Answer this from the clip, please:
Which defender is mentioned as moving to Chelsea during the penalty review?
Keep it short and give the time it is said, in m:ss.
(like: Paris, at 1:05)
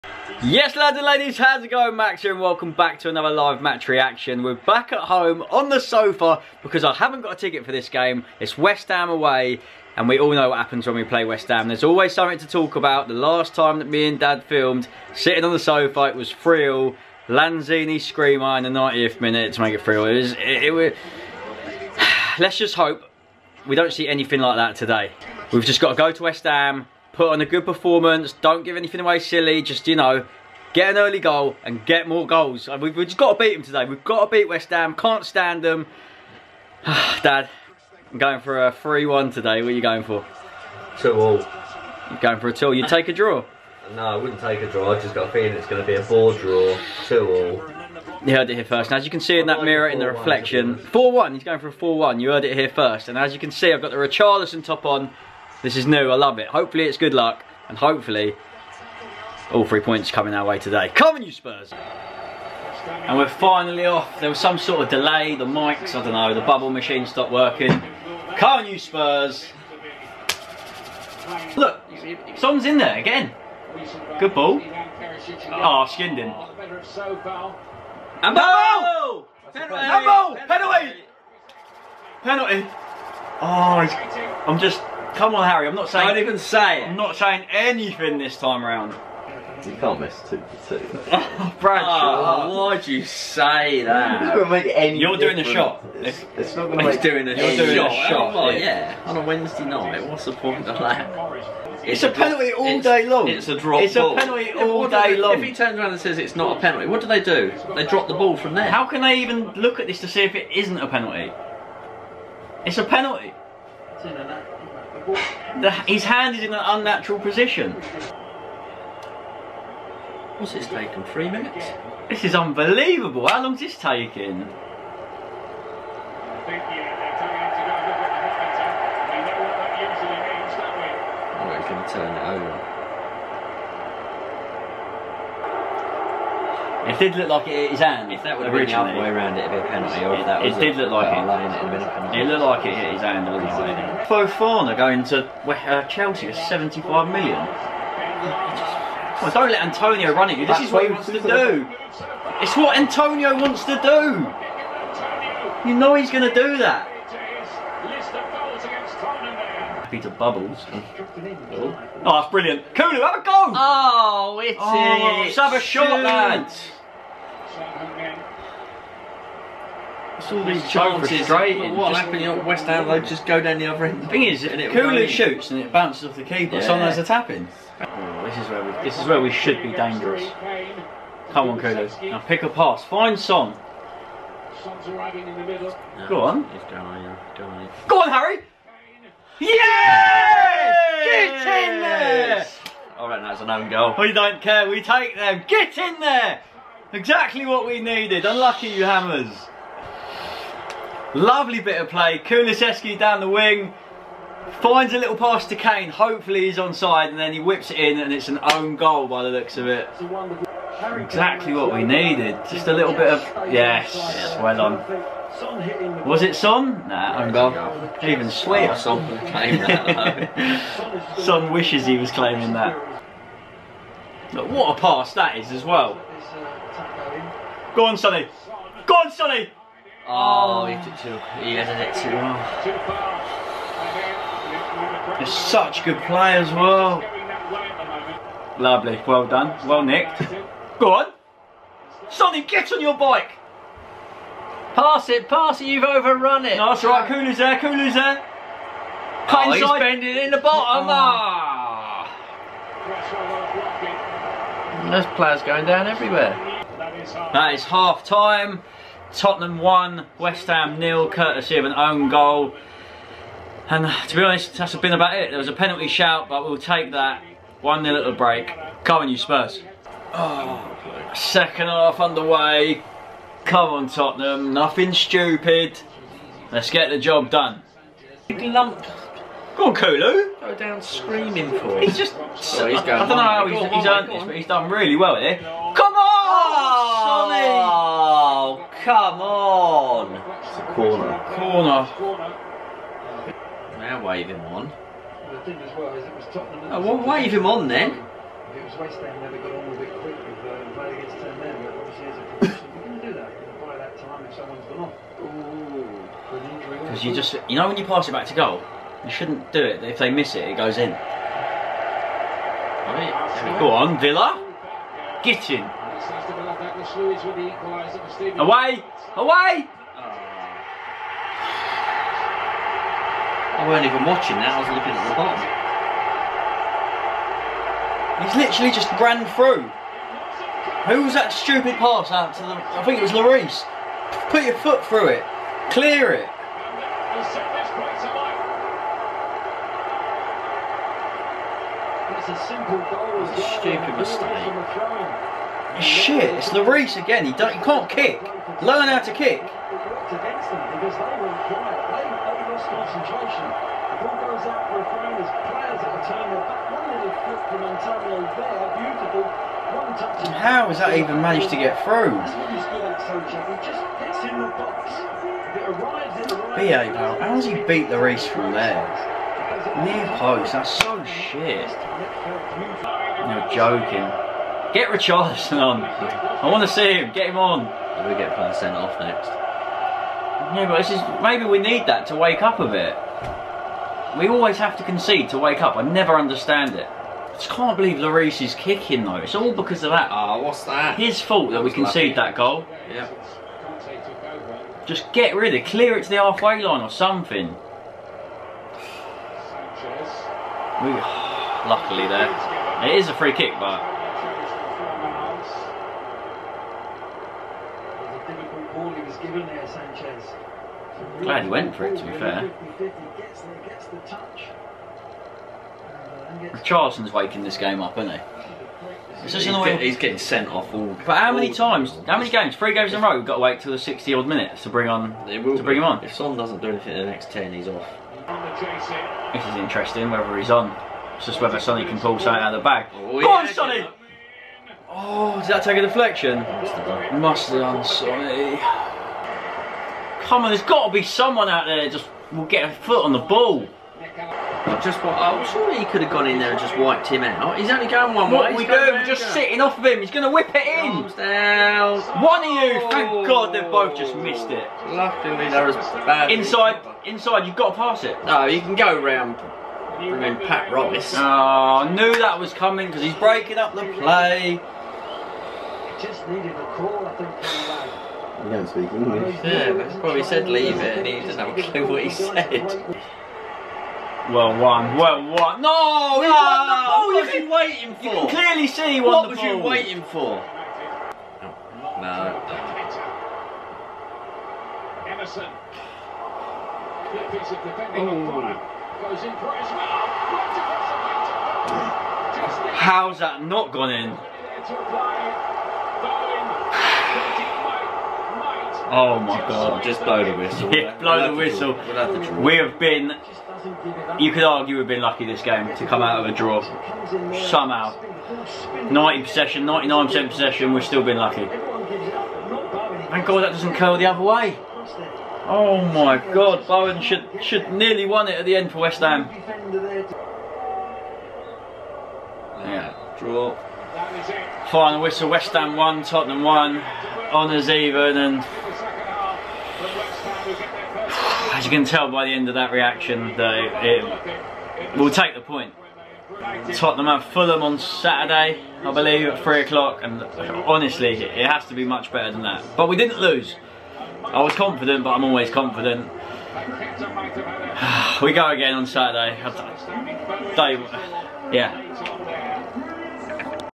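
Fofana, at 2:24.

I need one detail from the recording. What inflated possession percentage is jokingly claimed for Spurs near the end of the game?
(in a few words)
99%.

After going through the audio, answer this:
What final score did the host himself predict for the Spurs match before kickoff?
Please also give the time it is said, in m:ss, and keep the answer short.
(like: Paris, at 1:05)
3-1, at 0:38.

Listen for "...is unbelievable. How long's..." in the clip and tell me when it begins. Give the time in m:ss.
2:02.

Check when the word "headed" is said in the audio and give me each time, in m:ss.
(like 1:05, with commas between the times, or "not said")
3:51.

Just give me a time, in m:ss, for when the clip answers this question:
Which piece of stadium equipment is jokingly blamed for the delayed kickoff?
1:06.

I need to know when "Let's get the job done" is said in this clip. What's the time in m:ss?
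4:36.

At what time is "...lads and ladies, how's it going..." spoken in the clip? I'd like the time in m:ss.
0:00.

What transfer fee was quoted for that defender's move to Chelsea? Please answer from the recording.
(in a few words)
75 million.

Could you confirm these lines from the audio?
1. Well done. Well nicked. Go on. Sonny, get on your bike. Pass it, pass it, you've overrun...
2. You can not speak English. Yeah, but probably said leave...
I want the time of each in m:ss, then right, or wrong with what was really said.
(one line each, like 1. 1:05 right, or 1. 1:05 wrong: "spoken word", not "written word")
1. 3:59 right
2. 7:48 right.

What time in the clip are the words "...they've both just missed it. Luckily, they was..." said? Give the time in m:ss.
7:33.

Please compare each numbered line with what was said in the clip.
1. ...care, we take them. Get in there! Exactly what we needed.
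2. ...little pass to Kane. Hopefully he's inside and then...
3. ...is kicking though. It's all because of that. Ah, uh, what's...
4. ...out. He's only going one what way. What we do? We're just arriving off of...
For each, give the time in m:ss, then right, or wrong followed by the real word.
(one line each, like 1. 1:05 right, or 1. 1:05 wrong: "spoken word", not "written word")
1. 3:14 right
2. 3:24 wrong: "onside", not "inside"
3. 6:28 right
4. 7:27 wrong: "sitting", not "arriving".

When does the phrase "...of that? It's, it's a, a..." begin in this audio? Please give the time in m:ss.
1:40.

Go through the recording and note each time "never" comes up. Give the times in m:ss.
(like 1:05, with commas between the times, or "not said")
4:59, 6:25.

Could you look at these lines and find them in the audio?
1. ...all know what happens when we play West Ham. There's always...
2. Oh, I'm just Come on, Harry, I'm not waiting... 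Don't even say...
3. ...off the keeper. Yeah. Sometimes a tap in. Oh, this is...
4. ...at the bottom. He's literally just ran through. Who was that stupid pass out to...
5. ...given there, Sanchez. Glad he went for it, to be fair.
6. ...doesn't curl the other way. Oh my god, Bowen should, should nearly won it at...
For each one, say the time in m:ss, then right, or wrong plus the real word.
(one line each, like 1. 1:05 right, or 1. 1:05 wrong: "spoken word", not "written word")
1. 0:10 right
2. 1:23 wrong: "saying", not "waiting"
3. 2:56 right
4. 5:24 right
5. 6:49 right
6. 8:33 right.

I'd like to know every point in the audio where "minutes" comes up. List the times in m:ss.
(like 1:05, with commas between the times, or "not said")
0:19, 2:01, 7:04.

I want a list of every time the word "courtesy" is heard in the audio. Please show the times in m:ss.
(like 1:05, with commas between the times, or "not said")
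4:21.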